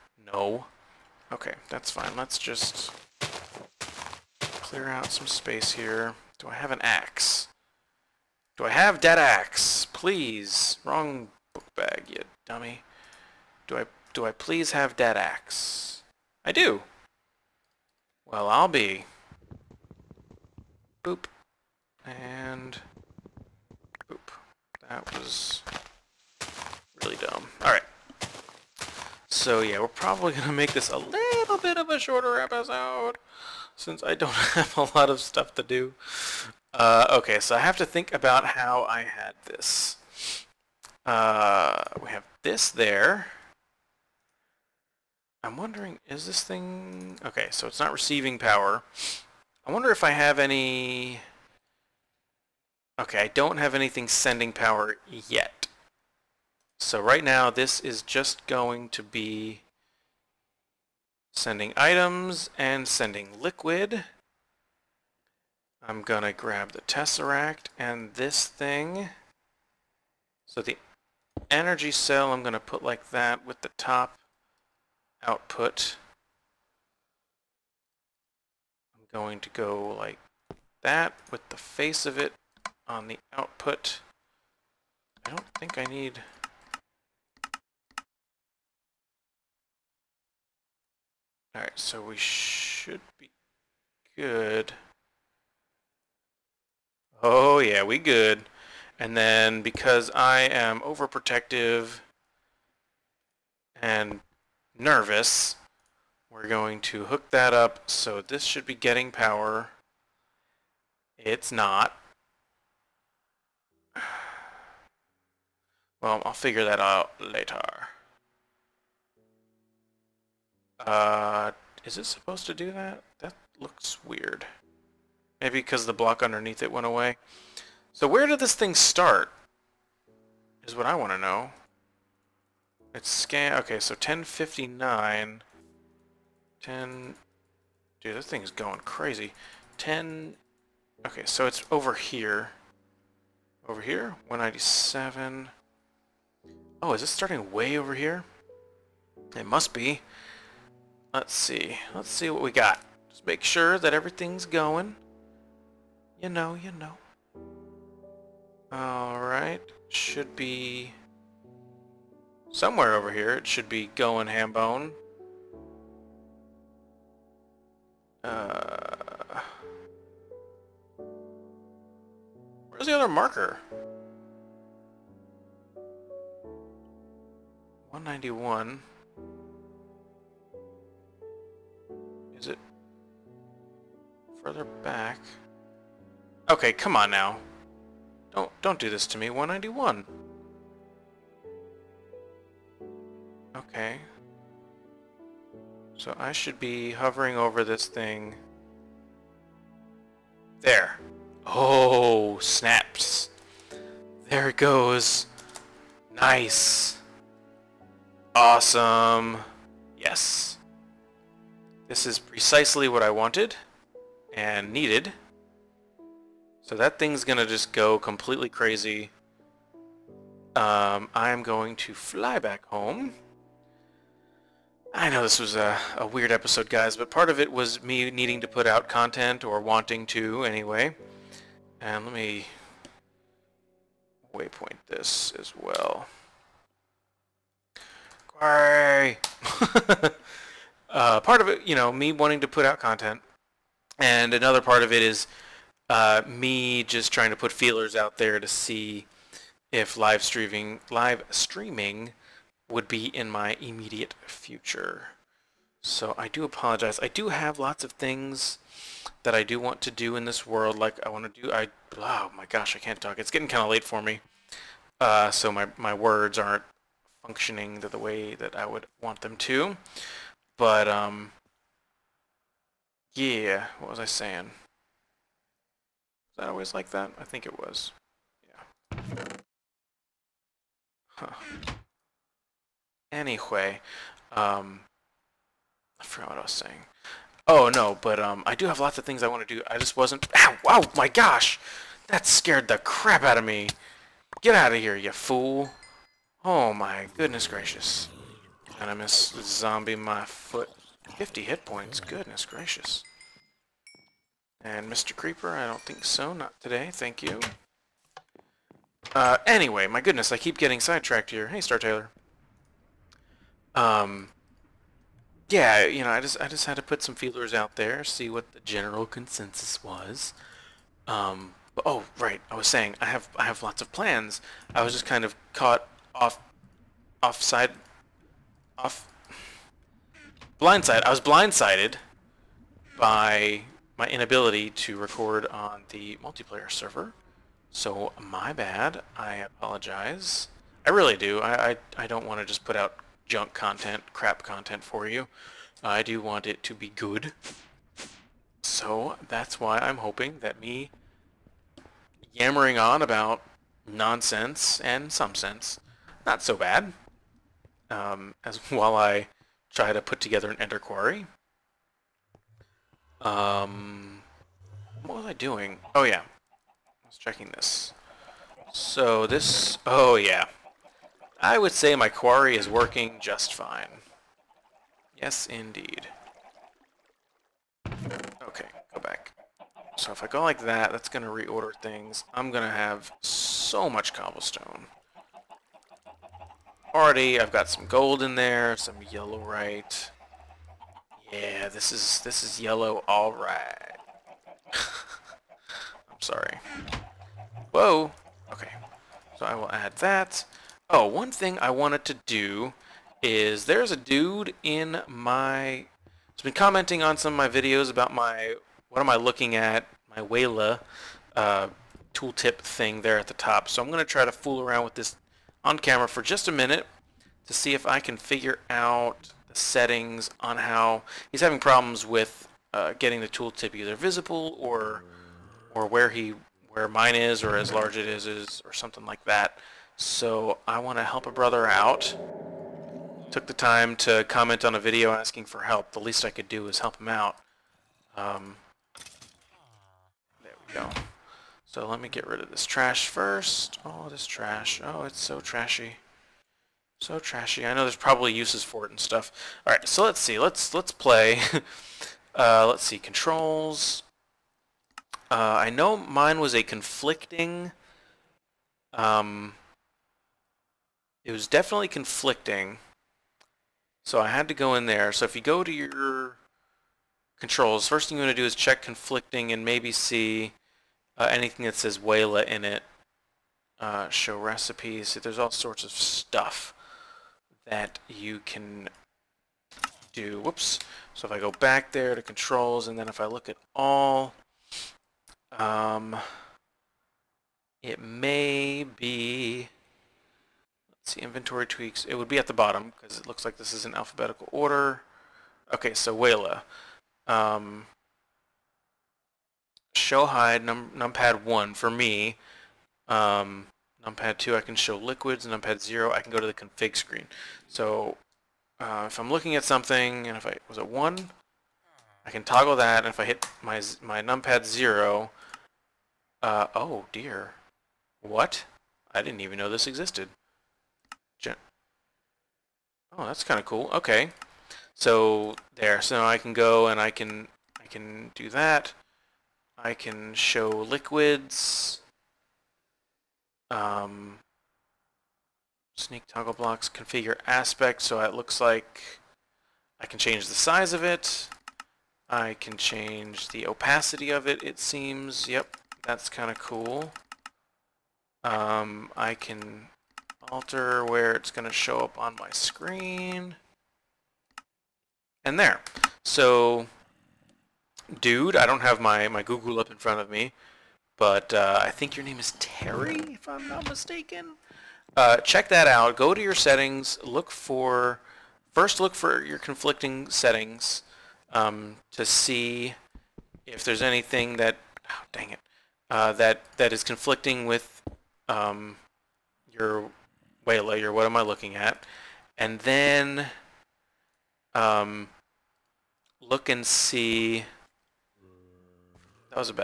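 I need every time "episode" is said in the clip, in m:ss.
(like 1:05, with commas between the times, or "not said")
0:32, 3:46.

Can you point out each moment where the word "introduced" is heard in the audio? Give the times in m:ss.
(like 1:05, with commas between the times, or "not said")
not said.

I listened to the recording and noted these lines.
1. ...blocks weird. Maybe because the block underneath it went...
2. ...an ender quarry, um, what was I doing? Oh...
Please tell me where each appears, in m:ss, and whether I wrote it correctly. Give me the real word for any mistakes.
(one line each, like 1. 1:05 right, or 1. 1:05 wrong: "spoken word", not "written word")
1. 2:03 wrong: "looks", not "blocks"
2. 6:00 right.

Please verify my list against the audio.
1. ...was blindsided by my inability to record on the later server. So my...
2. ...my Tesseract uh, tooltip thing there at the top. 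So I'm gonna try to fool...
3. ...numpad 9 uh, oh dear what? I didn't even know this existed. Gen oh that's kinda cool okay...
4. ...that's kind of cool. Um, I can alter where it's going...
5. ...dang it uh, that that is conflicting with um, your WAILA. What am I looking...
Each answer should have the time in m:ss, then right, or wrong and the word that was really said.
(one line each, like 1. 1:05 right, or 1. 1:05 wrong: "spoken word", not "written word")
1. 5:31 wrong: "multiplayer", not "later"
2. 6:50 wrong: "WAILA", not "Tesseract"
3. 8:34 wrong: "0", not "9"
4. 9:06 right
5. 9:35 right.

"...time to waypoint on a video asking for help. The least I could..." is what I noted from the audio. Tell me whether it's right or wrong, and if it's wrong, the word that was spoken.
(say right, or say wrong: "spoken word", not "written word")
wrong: "comment", not "waypoint".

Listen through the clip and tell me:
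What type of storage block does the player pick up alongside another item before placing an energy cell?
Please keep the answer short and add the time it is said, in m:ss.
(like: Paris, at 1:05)
Tesseract, at 1:06.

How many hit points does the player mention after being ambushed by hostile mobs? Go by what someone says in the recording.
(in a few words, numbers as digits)
50.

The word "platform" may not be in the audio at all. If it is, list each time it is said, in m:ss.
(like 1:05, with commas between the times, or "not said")
not said.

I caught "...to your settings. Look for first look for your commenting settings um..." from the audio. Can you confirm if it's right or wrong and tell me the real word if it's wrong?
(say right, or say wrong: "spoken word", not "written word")
wrong: "conflicting", not "commenting".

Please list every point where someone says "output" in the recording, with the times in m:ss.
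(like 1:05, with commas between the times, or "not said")
1:15, 1:23.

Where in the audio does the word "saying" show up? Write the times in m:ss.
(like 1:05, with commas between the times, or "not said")
4:34, 4:46, 5:22.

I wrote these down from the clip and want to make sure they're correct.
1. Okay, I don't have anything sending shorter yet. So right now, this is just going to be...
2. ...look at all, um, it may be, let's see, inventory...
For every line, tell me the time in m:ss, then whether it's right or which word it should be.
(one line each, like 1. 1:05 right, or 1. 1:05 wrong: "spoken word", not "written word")
1. 0:52 wrong: "power", not "shorter"
2. 8:03 right.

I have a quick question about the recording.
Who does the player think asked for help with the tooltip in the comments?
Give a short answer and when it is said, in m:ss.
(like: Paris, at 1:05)
Terry, at 9:22.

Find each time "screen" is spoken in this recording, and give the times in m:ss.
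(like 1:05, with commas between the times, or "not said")
8:26, 9:12.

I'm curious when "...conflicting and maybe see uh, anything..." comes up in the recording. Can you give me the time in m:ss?
7:48.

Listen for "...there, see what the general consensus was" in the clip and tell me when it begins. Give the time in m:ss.
5:17.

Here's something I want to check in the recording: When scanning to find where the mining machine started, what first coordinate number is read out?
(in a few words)
1059.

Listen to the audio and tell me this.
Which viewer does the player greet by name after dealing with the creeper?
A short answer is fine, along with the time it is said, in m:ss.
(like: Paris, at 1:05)
Star Taylor, at 5:11.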